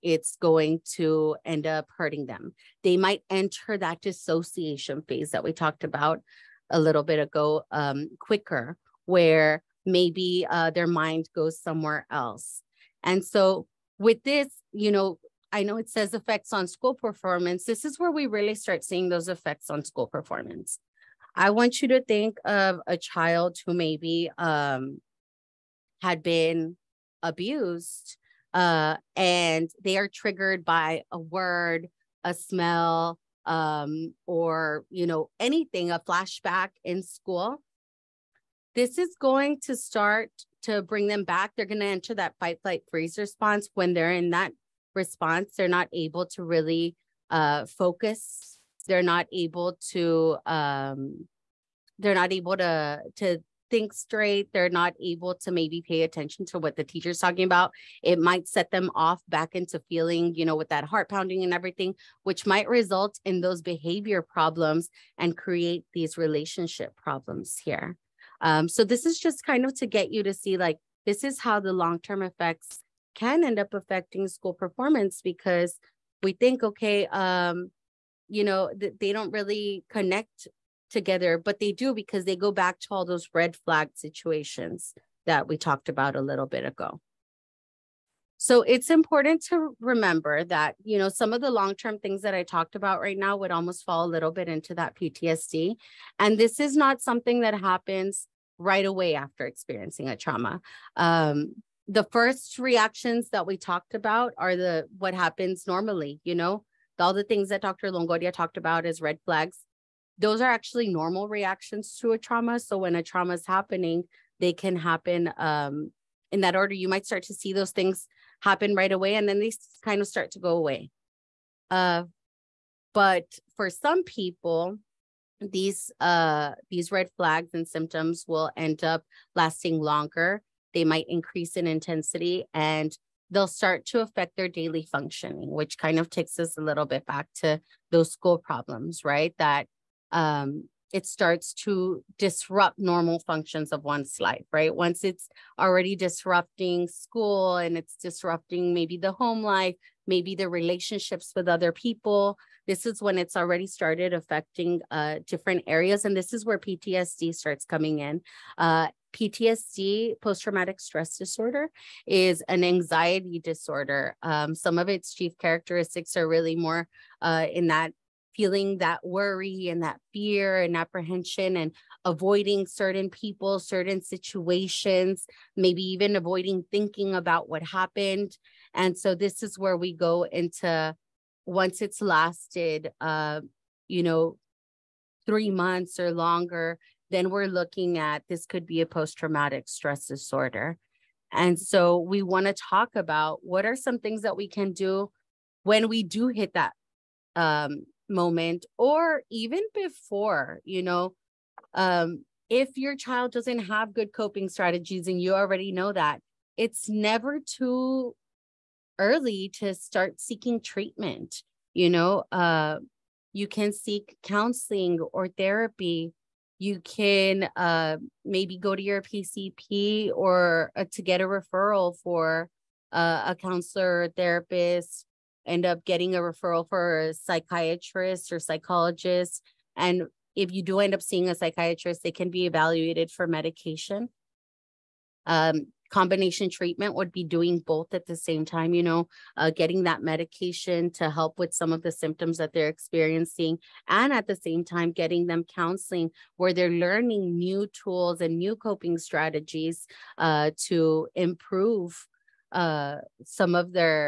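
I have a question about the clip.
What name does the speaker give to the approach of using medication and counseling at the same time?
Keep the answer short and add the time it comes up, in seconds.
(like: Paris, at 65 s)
combination treatment, at 235 s.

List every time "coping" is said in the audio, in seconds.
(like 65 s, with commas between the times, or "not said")
204 s, 248 s.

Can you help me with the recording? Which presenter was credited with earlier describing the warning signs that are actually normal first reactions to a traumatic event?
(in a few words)
Dr. Longoria.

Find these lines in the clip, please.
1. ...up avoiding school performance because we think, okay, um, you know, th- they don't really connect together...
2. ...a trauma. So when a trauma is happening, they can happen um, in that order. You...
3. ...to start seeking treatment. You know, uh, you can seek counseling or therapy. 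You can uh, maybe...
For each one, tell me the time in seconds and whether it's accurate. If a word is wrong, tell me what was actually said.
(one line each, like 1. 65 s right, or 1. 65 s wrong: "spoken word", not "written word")
1. 73 s wrong: "affecting", not "avoiding"
2. 112 s right
3. 209 s right.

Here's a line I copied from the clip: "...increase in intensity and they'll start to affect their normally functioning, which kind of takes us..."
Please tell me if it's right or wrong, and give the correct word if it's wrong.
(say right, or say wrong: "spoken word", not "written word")
wrong: "daily", not "normally".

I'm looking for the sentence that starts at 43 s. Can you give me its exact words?
When they're in that response, they're not able to really uh, focus.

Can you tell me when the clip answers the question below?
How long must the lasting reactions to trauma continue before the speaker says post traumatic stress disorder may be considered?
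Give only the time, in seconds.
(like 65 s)
185 s.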